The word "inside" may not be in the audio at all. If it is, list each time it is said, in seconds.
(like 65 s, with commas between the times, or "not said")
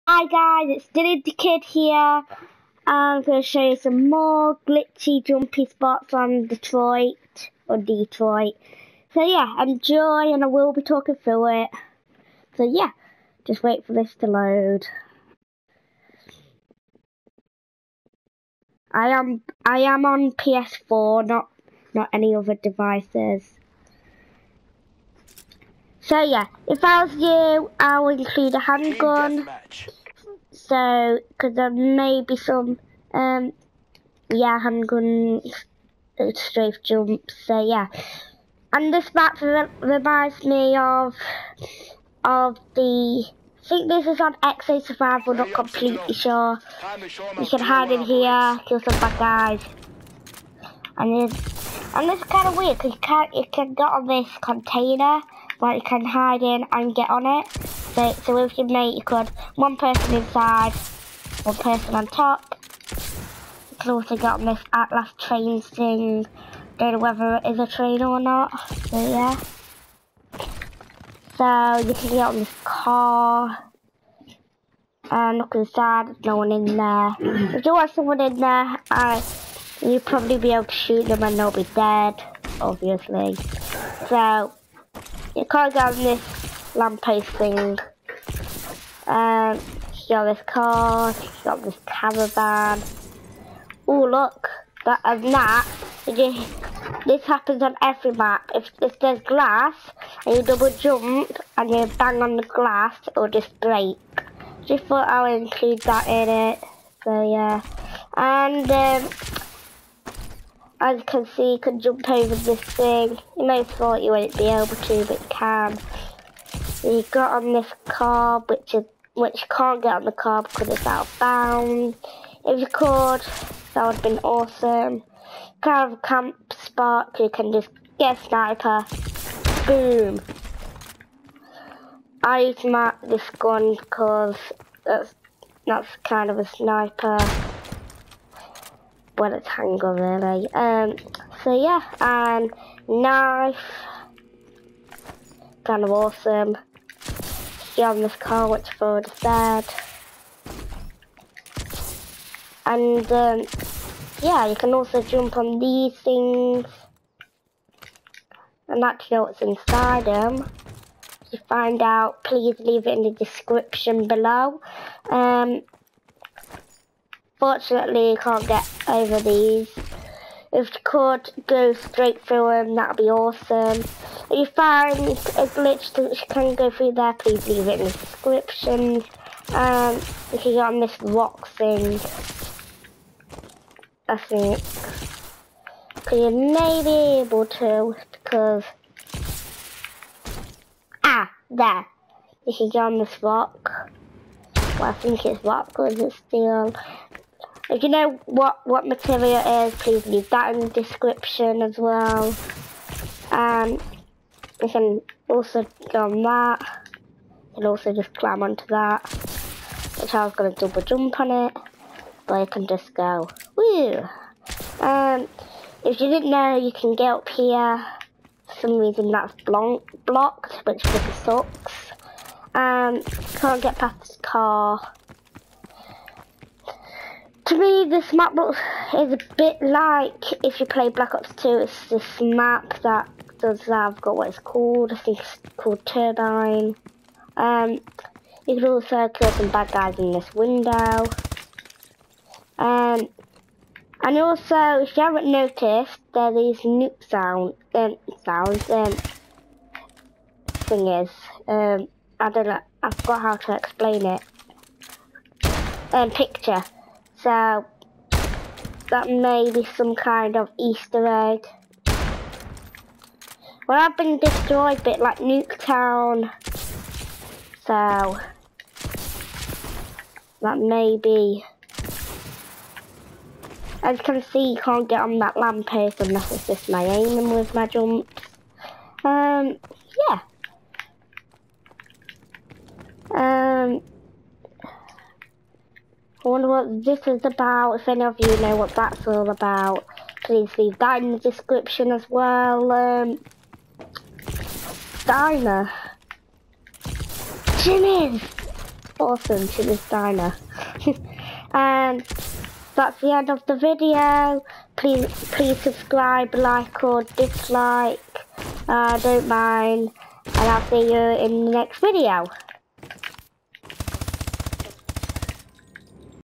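60 s, 75 s, 159 s.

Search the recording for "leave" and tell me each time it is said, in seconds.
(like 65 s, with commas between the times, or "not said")
162 s, 177 s, 200 s, 290 s.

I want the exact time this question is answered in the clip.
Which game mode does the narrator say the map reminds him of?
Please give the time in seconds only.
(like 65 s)
44 s.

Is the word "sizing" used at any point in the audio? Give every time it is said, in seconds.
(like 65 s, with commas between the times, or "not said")
not said.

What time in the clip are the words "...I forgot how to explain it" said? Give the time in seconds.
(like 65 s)
252 s.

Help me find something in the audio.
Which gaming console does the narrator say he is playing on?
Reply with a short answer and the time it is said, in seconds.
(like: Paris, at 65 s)
PS4, at 20 s.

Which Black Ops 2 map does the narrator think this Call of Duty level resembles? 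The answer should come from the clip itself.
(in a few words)
Turbine.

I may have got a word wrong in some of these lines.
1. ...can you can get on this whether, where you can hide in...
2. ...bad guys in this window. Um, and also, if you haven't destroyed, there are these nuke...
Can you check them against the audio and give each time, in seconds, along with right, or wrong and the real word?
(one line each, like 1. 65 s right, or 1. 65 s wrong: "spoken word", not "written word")
1. 53 s wrong: "container", not "whether"
2. 239 s wrong: "noticed", not "destroyed".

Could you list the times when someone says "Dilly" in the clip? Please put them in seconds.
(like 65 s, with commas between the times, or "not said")
0 s.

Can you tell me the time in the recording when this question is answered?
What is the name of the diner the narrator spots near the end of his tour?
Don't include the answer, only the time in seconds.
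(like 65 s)
299 s.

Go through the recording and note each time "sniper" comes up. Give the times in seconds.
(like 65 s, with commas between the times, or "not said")
128 s, 136 s.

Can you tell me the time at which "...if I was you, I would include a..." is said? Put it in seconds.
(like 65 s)
26 s.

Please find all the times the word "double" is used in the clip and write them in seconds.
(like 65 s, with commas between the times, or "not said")
100 s, 210 s.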